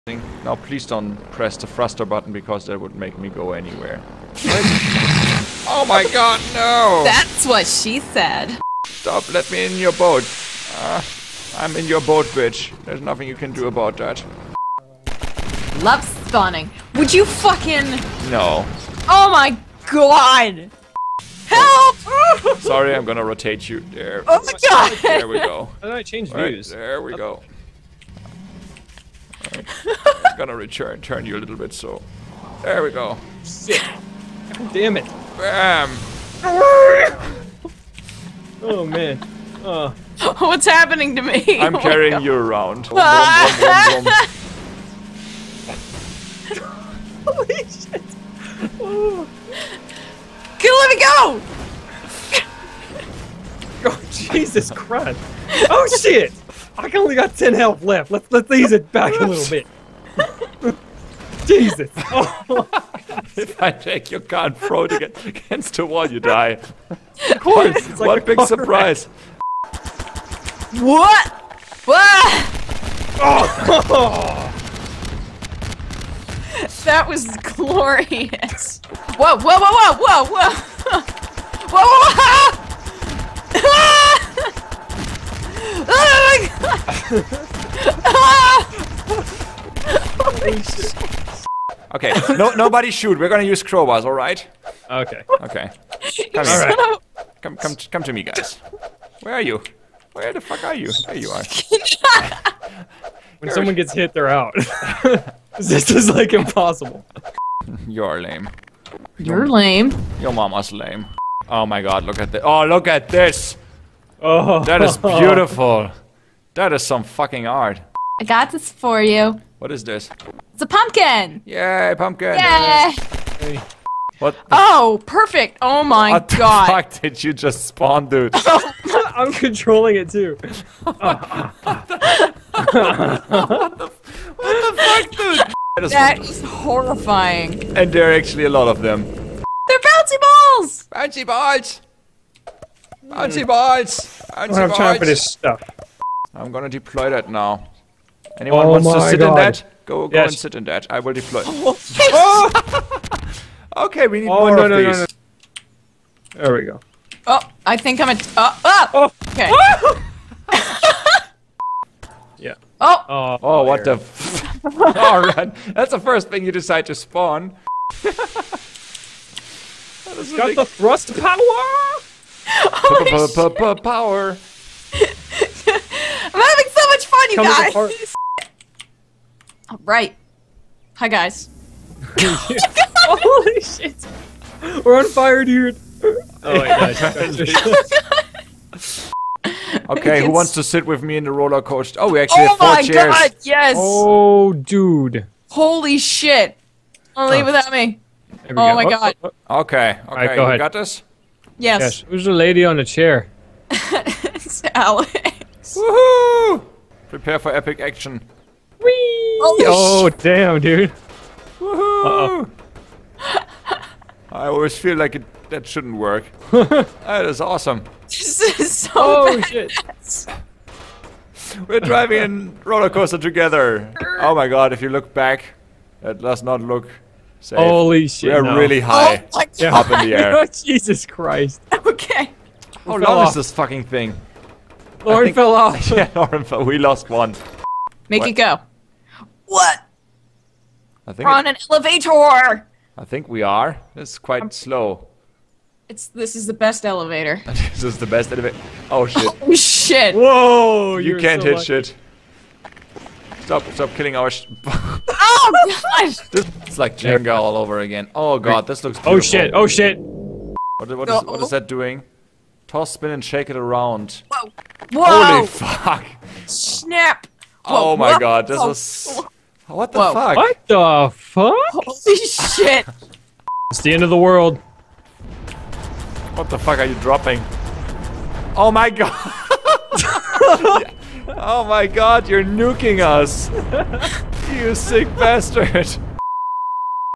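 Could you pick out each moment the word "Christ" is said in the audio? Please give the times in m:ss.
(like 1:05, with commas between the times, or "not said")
0:54, 3:51.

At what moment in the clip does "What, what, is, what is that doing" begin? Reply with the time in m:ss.
4:19.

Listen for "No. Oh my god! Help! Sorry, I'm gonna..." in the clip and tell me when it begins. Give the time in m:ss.
0:18.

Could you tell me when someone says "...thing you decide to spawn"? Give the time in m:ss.
2:46.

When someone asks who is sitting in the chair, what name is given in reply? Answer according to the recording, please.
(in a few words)
Alex.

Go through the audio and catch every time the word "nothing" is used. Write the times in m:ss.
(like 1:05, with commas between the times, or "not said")
0:12.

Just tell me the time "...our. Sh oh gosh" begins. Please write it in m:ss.
4:14.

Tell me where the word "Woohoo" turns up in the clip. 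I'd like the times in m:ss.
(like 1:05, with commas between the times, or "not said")
3:25, 3:31.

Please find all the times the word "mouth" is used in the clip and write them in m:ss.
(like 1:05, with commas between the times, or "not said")
not said.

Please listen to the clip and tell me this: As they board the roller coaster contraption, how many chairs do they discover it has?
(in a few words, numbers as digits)
4.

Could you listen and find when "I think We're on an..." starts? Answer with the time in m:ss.
4:01.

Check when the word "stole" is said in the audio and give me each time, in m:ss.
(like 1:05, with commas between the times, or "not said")
not said.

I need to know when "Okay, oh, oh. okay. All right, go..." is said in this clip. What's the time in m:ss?
3:19.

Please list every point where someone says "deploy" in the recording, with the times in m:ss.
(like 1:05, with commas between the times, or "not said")
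2:26, 2:31.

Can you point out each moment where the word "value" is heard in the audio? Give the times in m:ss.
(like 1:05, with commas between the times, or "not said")
not said.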